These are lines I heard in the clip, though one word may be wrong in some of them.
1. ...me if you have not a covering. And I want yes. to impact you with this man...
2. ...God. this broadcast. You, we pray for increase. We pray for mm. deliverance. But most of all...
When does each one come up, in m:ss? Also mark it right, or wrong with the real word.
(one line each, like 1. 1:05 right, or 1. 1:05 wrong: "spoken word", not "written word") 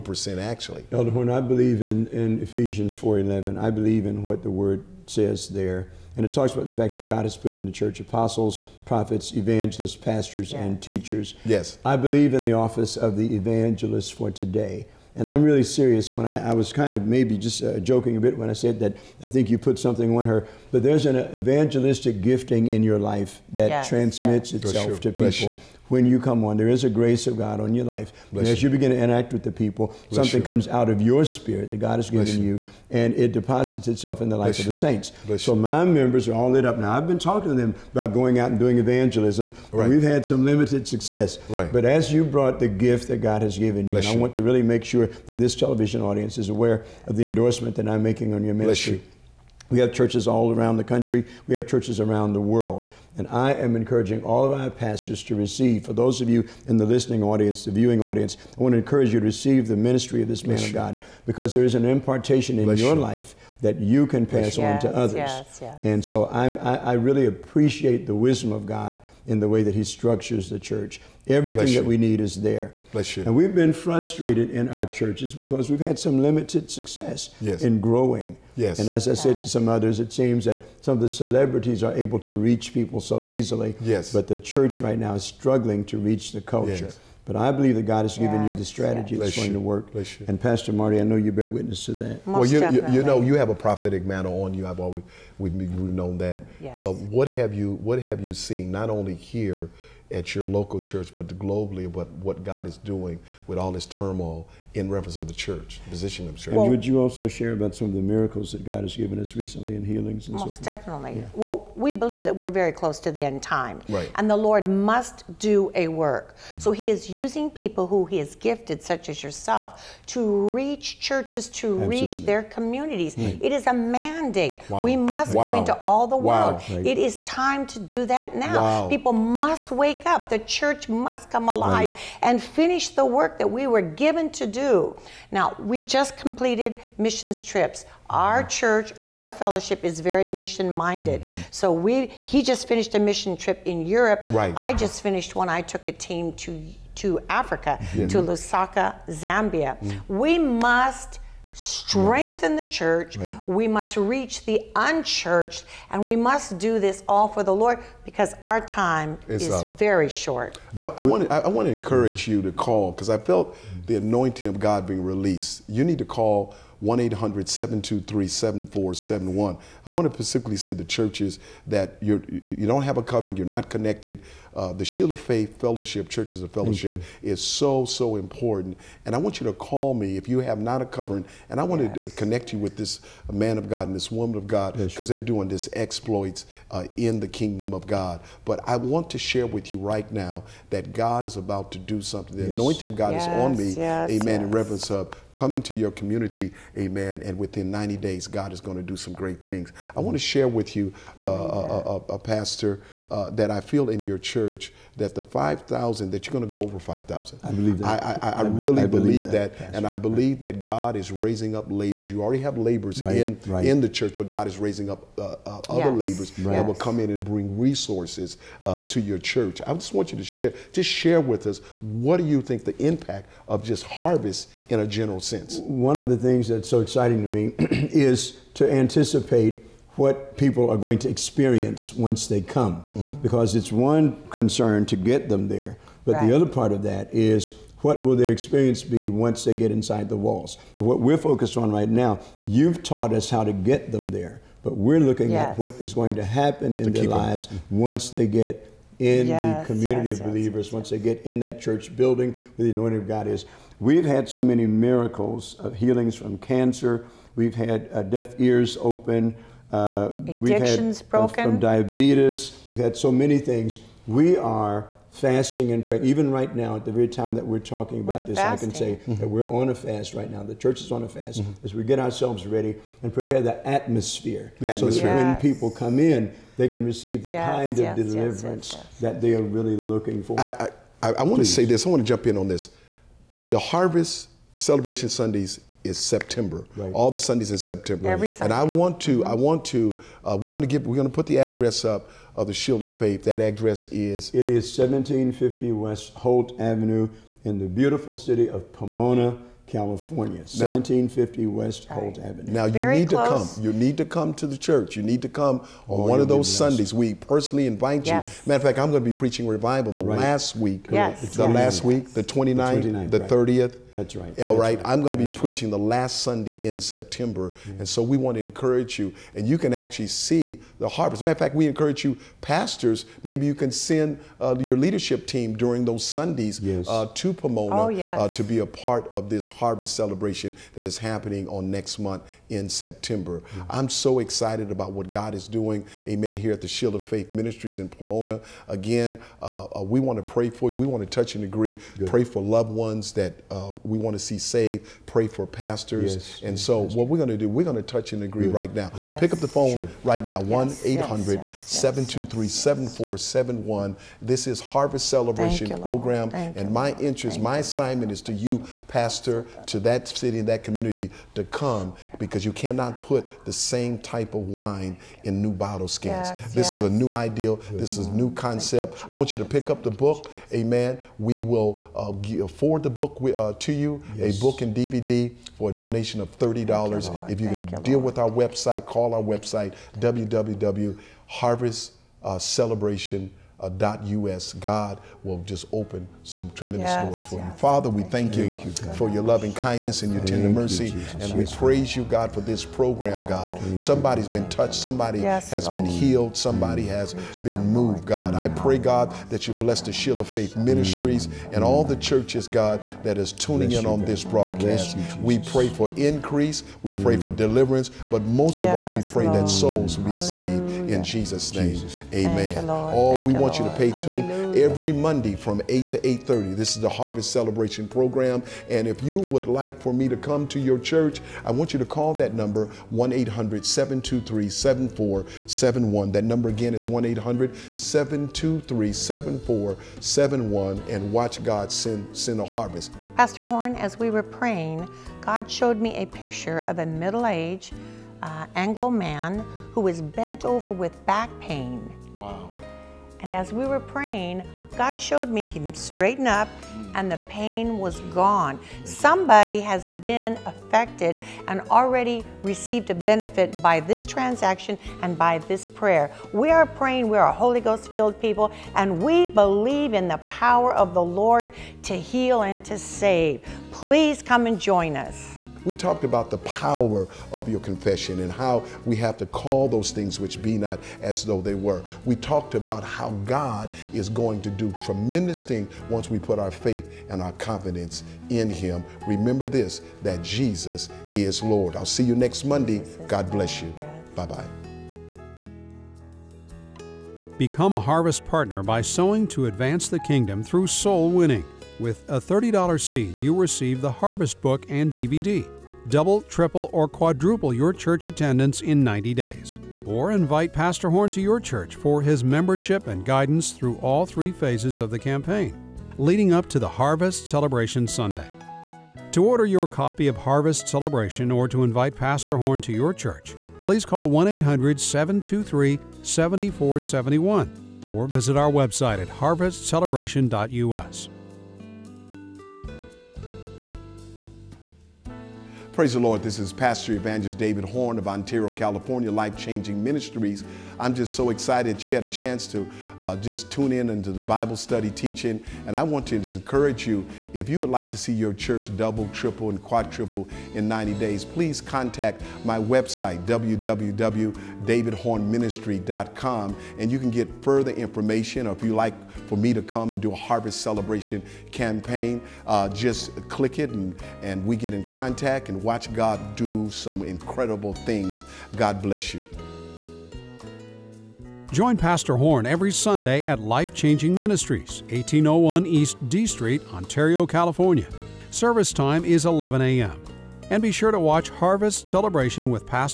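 1. 2:59 wrong: "connect", not "impact"
2. 6:43 right.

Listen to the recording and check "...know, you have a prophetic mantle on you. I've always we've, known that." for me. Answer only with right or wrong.
right.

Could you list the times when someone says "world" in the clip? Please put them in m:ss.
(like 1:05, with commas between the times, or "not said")
0:52, 2:06.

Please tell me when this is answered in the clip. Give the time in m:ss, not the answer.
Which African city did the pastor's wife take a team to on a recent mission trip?
2:28.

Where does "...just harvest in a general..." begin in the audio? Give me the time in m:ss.
3:43.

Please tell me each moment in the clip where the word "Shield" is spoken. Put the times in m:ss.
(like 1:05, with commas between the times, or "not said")
2:54, 4:52, 5:36, 6:39.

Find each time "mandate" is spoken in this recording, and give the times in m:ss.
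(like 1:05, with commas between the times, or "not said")
2:03.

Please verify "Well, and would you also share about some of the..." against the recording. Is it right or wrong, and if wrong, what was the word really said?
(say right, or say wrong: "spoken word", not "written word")
right.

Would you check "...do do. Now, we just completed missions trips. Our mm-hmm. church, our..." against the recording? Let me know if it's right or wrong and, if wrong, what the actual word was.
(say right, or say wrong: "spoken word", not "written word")
right.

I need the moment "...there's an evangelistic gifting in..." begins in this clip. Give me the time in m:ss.
0:20.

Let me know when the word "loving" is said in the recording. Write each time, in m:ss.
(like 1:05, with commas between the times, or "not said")
6:29.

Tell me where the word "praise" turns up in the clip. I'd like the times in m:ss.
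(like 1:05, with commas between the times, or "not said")
6:31, 8:45.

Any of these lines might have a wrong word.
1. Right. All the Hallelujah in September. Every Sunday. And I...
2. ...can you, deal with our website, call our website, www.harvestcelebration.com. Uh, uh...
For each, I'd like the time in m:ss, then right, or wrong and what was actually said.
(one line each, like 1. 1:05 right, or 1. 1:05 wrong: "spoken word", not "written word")
1. 4:46 wrong: "Sundays", not "Hallelujah"
2. 6:17 right.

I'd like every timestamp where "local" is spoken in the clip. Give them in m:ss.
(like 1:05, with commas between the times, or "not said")
1:40.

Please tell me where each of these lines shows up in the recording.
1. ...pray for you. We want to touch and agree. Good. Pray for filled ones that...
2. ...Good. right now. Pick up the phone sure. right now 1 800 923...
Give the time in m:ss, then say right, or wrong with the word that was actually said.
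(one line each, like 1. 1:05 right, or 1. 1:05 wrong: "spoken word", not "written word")
1. 5:40 wrong: "loved", not "filled"
2. 5:48 wrong: "723", not "923".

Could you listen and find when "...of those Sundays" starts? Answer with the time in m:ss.
5:06.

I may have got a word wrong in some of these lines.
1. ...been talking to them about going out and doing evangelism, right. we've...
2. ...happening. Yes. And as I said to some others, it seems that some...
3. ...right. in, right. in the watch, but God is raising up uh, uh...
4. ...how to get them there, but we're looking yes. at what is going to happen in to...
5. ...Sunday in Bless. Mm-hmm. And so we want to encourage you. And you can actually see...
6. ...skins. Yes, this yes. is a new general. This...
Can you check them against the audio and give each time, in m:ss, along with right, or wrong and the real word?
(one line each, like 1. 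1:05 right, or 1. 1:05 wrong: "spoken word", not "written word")
1. 0:37 right
2. 1:17 wrong: "growing", not "happening"
3. 3:33 wrong: "church", not "watch"
4. 4:03 right
5. 5:16 wrong: "September", not "Bless"
6. 6:05 wrong: "ideal", not "general".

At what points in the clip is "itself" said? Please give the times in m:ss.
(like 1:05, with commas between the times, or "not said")
0:24, 0:33.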